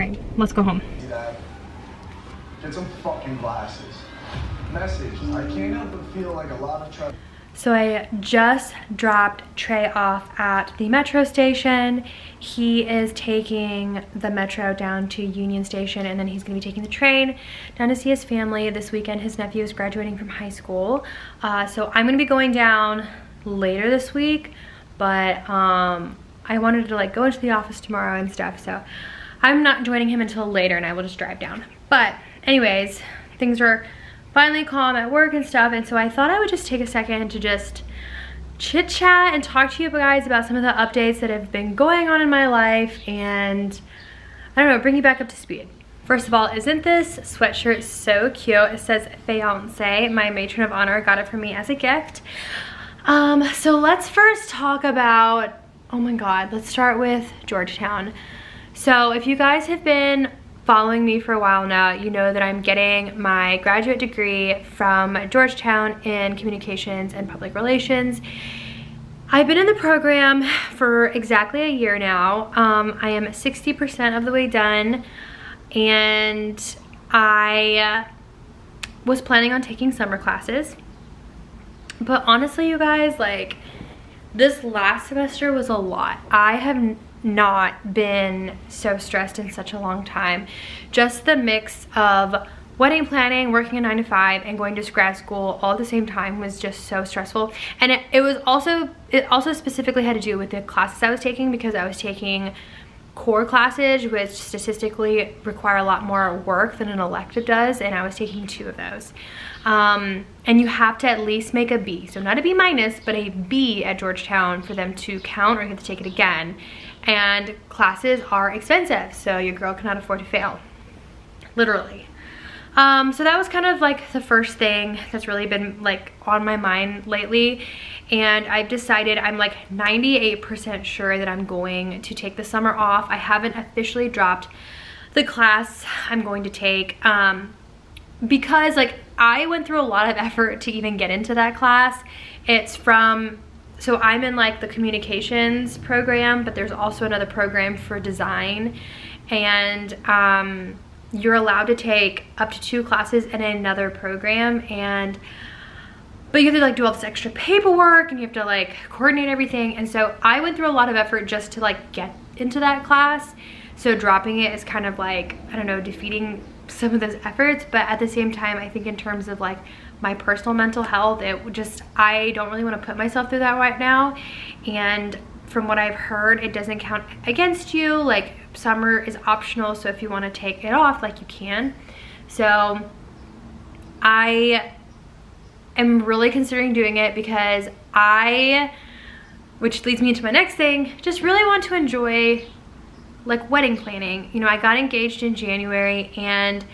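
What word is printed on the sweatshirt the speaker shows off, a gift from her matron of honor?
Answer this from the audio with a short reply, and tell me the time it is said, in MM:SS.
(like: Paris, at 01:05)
Fiance, at 00:49.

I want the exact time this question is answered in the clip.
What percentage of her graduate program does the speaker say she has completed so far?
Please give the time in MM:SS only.
01:13.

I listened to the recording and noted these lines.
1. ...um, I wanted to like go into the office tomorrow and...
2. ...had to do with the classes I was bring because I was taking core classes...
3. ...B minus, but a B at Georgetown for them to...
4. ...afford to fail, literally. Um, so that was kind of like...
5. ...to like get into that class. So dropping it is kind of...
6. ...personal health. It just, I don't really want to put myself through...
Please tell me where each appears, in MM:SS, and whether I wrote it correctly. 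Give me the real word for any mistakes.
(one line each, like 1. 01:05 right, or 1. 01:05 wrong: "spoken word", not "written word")
1. 00:25 right
2. 01:40 wrong: "taking", not "bring"
3. 01:52 right
4. 01:59 right
5. 02:41 right
6. 02:50 wrong: "mental", not "personal".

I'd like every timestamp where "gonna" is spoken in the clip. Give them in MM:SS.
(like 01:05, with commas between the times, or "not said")
00:16, 00:22.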